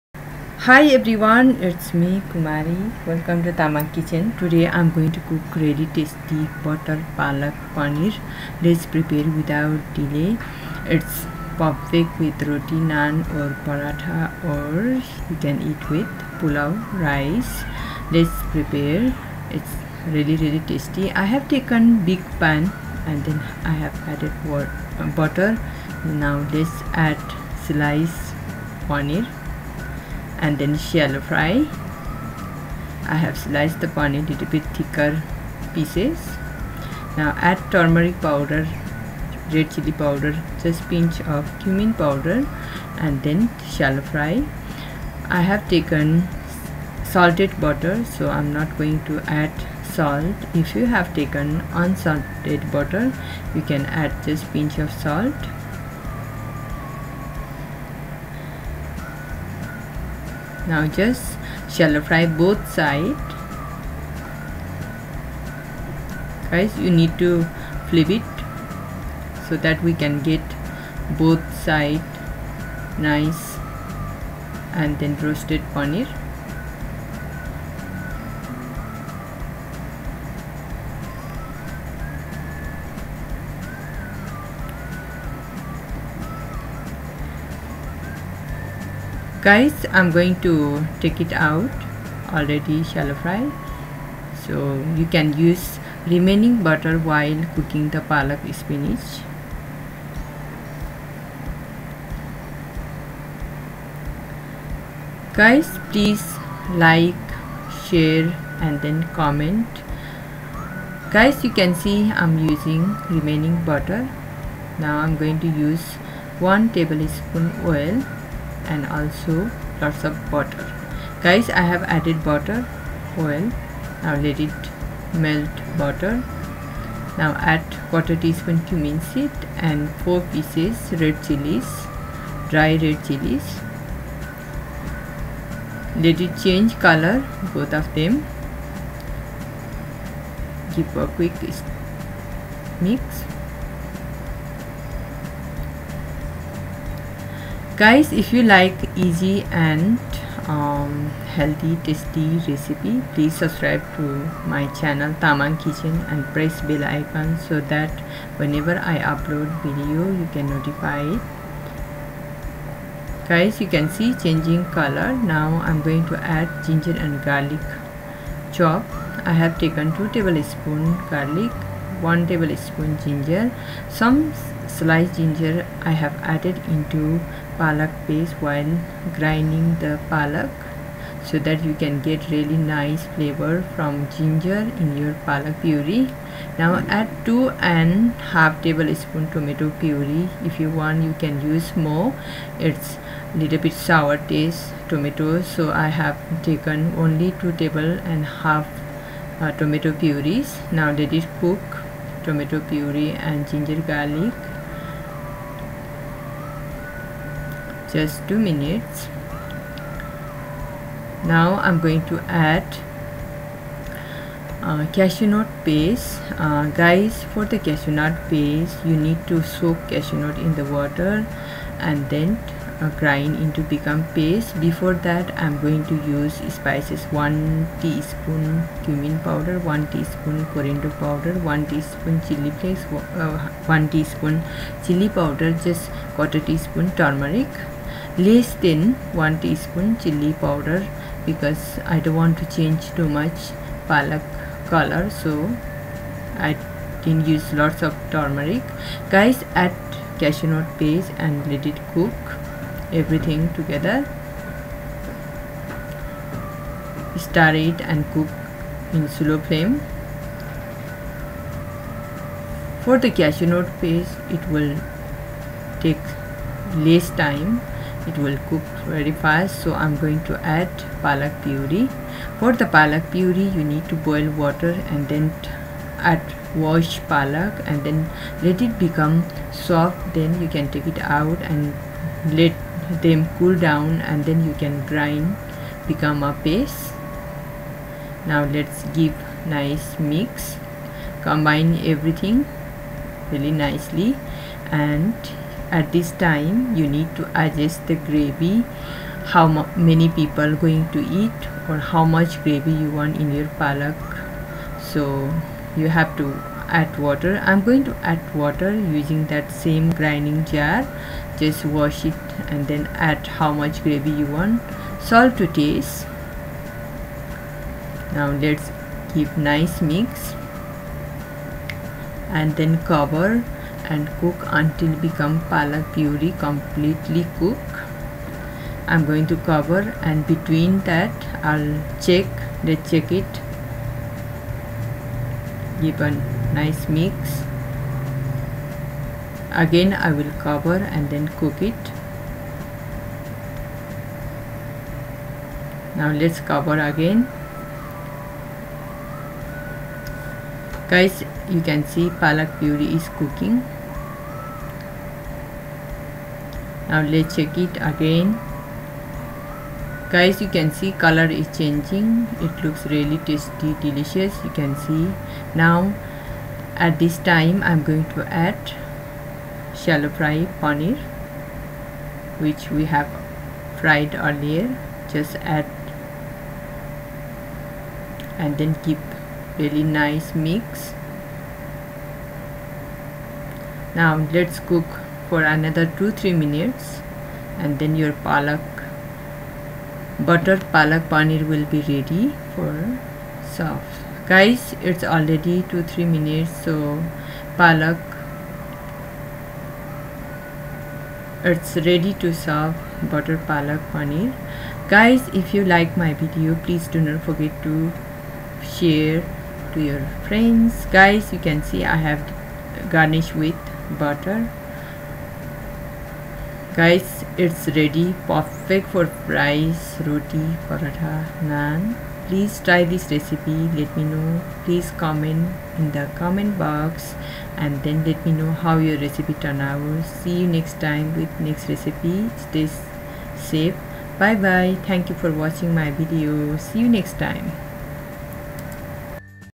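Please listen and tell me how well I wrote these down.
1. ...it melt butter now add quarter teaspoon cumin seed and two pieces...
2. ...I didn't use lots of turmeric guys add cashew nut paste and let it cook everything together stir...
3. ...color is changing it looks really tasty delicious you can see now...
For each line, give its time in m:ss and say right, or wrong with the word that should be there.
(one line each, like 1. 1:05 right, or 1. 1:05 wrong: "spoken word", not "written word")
1. 2:04 wrong: "four", not "two"
2. 4:06 right
3. 6:01 right.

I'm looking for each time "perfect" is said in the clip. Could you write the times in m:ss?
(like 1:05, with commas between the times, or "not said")
0:11, 6:58.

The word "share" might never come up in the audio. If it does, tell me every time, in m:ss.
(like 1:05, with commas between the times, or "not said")
1:47, 6:48.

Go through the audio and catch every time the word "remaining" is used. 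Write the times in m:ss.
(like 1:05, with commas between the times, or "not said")
1:36, 1:53.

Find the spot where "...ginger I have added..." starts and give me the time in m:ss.
2:55.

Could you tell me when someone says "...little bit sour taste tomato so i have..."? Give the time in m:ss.
3:13.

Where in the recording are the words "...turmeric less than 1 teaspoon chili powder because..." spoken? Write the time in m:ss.
3:56.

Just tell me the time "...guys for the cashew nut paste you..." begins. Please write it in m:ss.
3:36.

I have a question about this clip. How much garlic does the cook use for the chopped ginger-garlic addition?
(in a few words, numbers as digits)
2 tablespoons.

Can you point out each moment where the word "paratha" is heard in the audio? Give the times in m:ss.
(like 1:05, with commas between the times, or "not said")
0:13, 7:00.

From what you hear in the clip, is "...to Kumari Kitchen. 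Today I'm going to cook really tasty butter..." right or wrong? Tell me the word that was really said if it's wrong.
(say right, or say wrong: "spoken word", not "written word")
wrong: "Tamang", not "Kumari".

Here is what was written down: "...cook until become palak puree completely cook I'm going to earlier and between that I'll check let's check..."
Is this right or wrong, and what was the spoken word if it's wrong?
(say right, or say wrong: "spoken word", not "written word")
wrong: "cover", not "earlier".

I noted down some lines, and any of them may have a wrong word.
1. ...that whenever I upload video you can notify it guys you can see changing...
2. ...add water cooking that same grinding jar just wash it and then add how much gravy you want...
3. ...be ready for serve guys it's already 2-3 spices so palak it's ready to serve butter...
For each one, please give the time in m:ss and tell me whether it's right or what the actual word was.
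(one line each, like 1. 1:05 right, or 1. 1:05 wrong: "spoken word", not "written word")
1. 2:37 right
2. 5:08 wrong: "using", not "cooking"
3. 6:31 wrong: "minutes", not "spices".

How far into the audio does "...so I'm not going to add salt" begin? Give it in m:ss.
0:48.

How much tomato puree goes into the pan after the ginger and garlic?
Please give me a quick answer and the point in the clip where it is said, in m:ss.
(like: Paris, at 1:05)
2.5 tablespoons, at 3:07.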